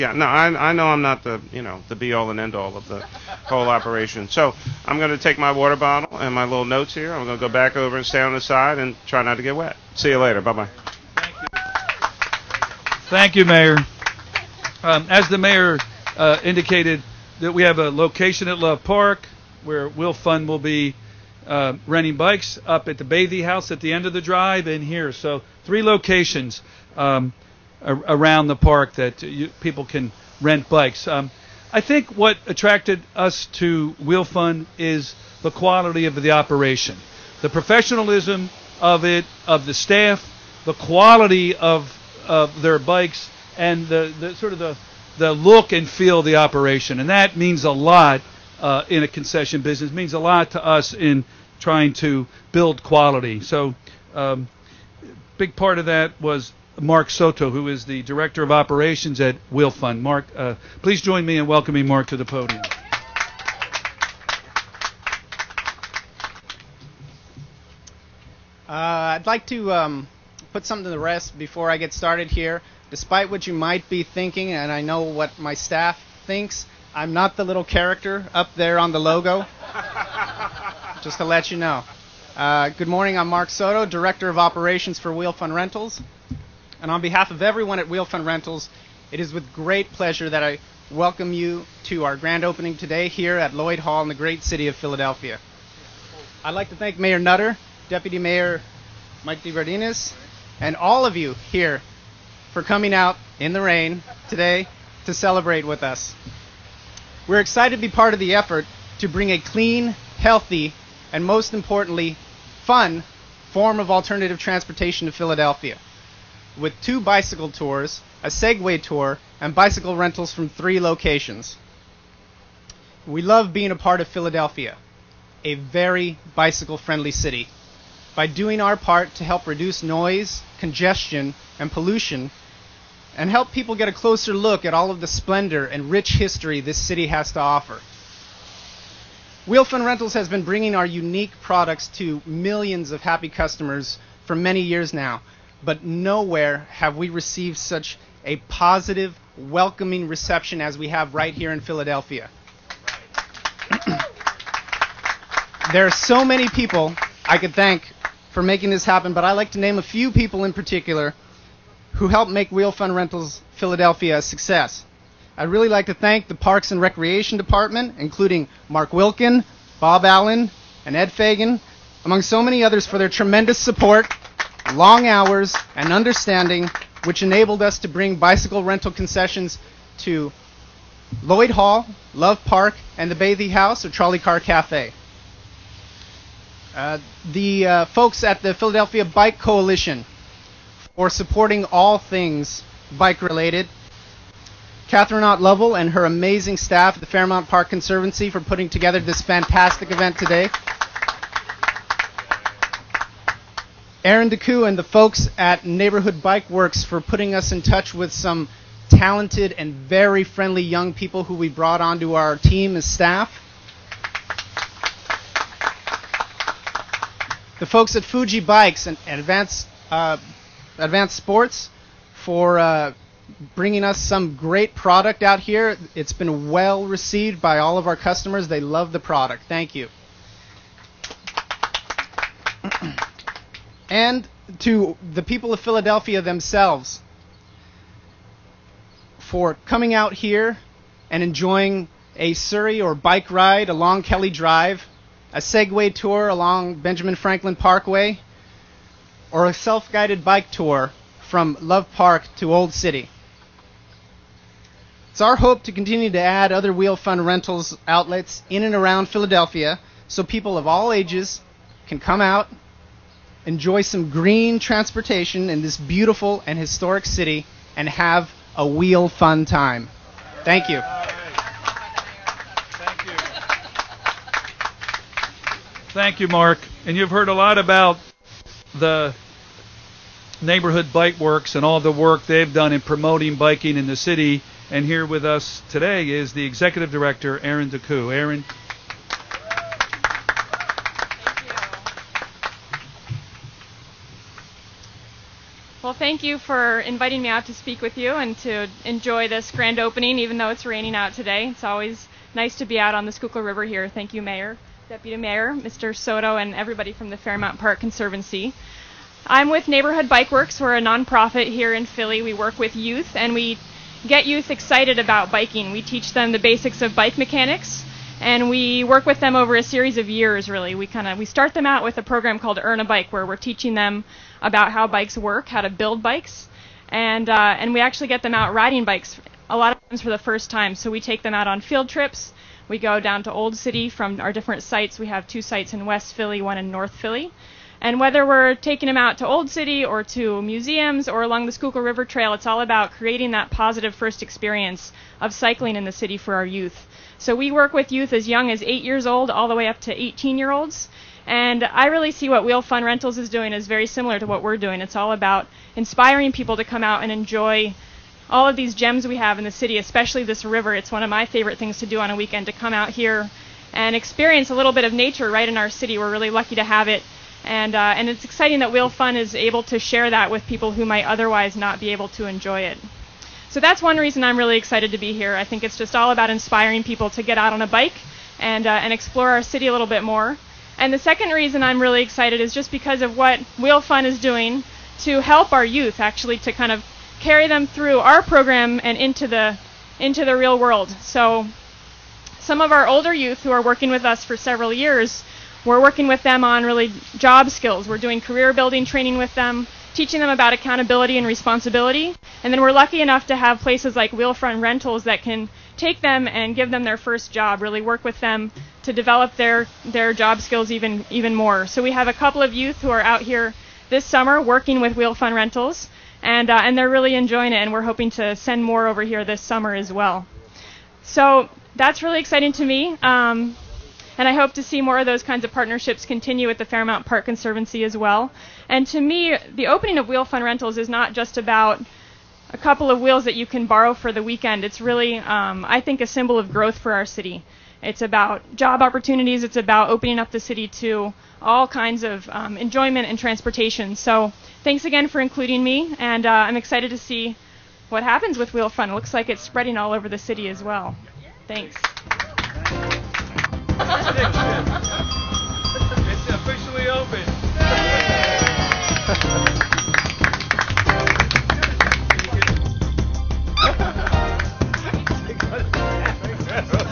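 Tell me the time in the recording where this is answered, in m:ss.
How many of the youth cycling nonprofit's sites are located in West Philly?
5:35.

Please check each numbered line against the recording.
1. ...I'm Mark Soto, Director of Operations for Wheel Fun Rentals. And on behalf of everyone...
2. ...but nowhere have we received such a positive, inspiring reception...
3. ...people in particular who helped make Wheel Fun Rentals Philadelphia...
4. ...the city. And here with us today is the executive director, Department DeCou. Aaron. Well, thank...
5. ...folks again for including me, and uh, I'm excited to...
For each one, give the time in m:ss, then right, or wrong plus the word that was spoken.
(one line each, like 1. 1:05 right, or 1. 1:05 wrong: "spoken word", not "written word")
1. 1:23 right
2. 2:25 wrong: "welcoming", not "inspiring"
3. 2:40 right
4. 4:43 wrong: "Aaron", not "Department"
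5. 7:24 wrong: "thanks", not "folks".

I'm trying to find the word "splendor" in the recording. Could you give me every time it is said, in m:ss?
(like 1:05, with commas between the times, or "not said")
2:15.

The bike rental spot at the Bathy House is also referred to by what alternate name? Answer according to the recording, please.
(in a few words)
Trolley Car Cafe.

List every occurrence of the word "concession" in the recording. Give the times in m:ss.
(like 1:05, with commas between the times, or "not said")
0:49, 2:58.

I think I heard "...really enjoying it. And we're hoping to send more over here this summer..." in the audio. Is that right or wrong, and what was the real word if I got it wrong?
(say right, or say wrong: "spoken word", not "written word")
right.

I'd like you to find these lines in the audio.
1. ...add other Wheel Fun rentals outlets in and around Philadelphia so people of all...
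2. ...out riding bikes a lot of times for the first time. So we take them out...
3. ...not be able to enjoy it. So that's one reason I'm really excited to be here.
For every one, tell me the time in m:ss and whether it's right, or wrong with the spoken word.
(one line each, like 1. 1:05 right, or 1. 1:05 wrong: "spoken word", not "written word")
1. 4:16 right
2. 5:28 right
3. 6:11 right.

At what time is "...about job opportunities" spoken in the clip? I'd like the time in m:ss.
7:18.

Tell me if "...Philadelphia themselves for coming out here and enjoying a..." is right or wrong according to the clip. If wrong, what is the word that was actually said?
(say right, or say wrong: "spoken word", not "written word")
right.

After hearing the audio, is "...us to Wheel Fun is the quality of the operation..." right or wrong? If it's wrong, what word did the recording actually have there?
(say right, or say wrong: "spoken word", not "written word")
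right.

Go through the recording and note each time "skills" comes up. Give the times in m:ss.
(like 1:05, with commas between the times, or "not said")
6:37, 6:50.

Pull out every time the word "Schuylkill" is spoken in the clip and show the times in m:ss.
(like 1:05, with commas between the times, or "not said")
5:03, 5:41.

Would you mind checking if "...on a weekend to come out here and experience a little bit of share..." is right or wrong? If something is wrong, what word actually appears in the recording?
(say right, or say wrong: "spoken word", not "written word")
wrong: "nature", not "share".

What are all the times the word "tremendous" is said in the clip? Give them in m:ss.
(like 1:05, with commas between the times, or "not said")
2:53.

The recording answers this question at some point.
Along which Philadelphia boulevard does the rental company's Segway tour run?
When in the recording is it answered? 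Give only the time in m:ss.
4:06.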